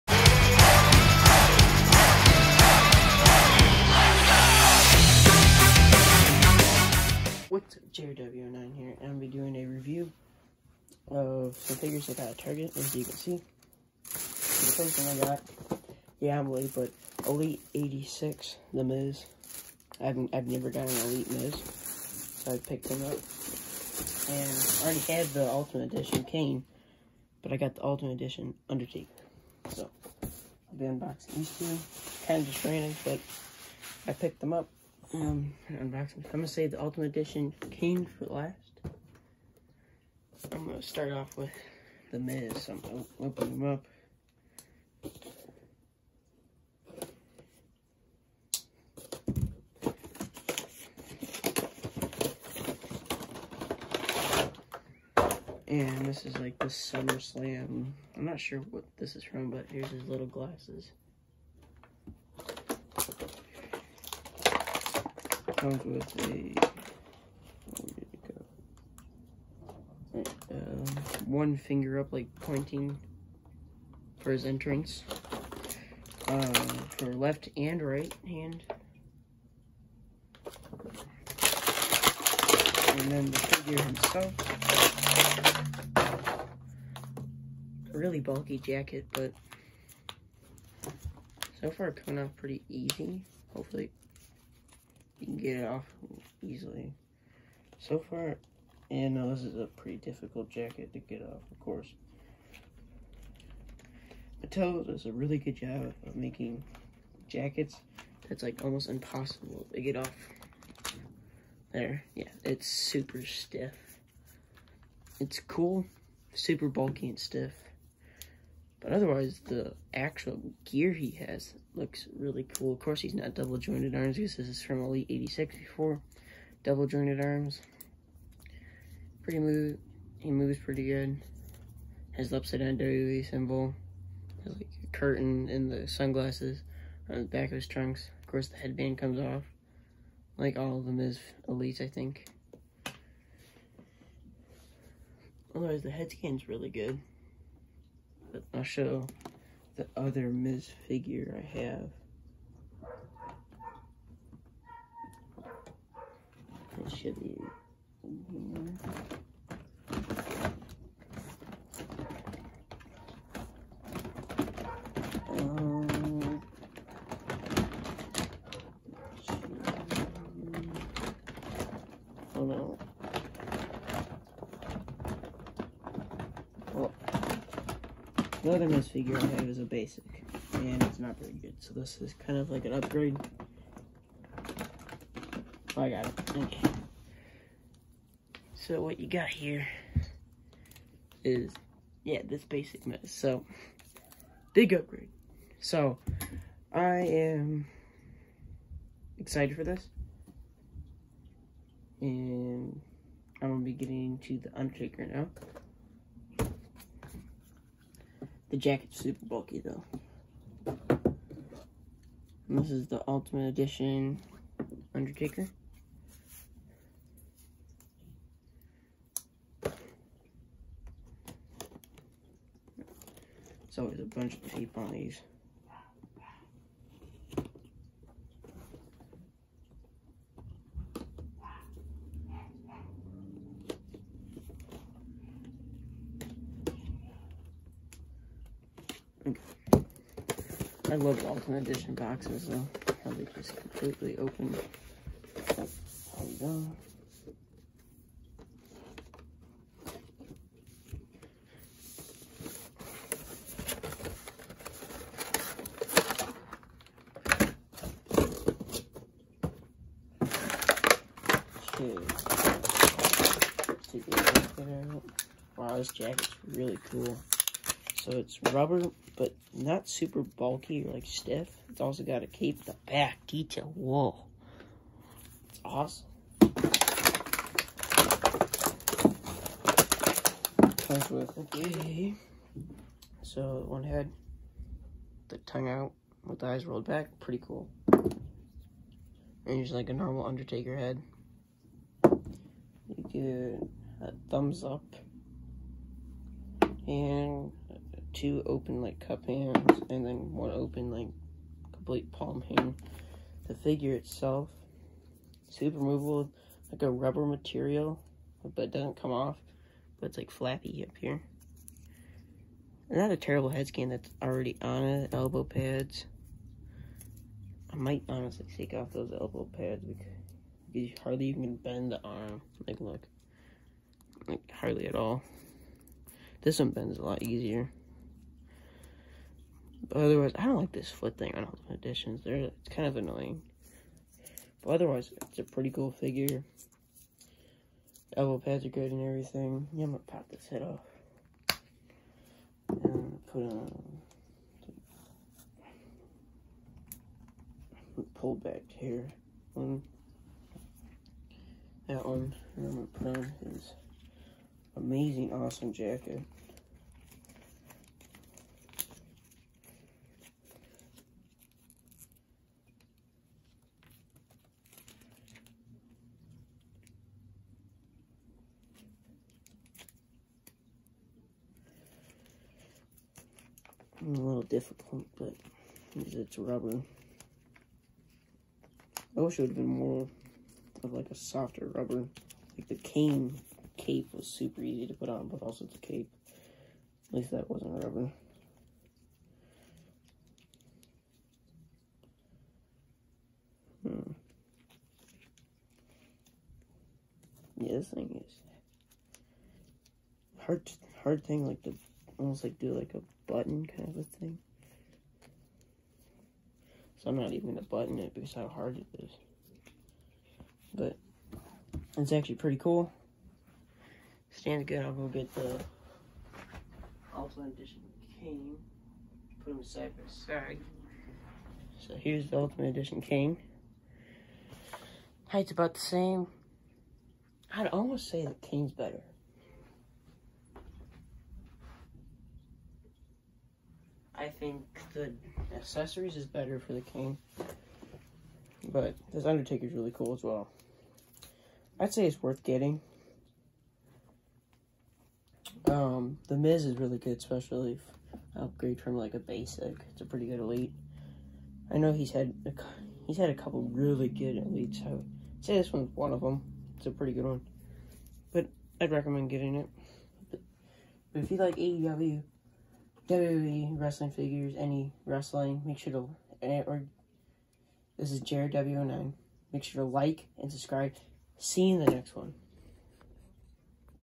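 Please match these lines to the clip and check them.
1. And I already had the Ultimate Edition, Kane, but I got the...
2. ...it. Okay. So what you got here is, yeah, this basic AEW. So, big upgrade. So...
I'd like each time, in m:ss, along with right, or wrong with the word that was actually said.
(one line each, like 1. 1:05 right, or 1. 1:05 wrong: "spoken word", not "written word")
1. 0:24 right
2. 3:06 wrong: "Miz", not "AEW".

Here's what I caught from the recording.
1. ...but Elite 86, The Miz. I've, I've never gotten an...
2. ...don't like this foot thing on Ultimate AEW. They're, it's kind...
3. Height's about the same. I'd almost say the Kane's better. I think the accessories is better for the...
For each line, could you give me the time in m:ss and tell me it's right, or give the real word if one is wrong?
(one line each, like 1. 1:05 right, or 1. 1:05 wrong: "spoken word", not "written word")
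1. 0:16 right
2. 5:30 wrong: "Editions", not "AEW"
3. 7:05 right.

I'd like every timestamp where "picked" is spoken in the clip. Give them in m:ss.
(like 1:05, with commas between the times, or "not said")
0:22, 0:34.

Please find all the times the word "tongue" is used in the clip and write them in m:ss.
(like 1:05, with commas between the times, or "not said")
4:45.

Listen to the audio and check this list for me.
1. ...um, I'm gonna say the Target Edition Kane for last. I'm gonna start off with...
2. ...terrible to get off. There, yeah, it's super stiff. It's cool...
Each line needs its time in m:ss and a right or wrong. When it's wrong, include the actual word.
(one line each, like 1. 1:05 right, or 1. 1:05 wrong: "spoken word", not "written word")
1. 0:35 wrong: "Ultimate", not "Target"
2. 1:48 wrong: "impossible", not "terrible".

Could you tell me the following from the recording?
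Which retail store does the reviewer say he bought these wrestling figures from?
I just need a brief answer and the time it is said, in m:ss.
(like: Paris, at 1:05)
Target, at 0:12.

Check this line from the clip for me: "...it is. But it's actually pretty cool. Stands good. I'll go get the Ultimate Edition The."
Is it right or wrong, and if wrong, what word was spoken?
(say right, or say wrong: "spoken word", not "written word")
wrong: "Kane", not "The".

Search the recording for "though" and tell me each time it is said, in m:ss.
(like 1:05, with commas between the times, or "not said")
3:29, 4:02.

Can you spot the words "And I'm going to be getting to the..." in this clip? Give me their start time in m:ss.
3:22.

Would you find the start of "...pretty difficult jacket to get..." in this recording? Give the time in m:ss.
1:39.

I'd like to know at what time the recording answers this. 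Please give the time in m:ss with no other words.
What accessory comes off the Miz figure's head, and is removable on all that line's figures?
2:18.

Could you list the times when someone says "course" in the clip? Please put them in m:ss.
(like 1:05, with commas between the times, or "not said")
1:41, 2:02, 2:18.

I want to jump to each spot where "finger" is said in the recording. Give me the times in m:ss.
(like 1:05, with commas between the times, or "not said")
1:11.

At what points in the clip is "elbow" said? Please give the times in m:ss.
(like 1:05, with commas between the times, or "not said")
5:15, 5:19, 5:38.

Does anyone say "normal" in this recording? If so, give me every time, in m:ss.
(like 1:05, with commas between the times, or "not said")
4:49.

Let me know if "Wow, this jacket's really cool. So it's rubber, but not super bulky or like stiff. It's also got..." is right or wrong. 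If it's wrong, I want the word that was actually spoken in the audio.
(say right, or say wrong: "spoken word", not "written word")
right.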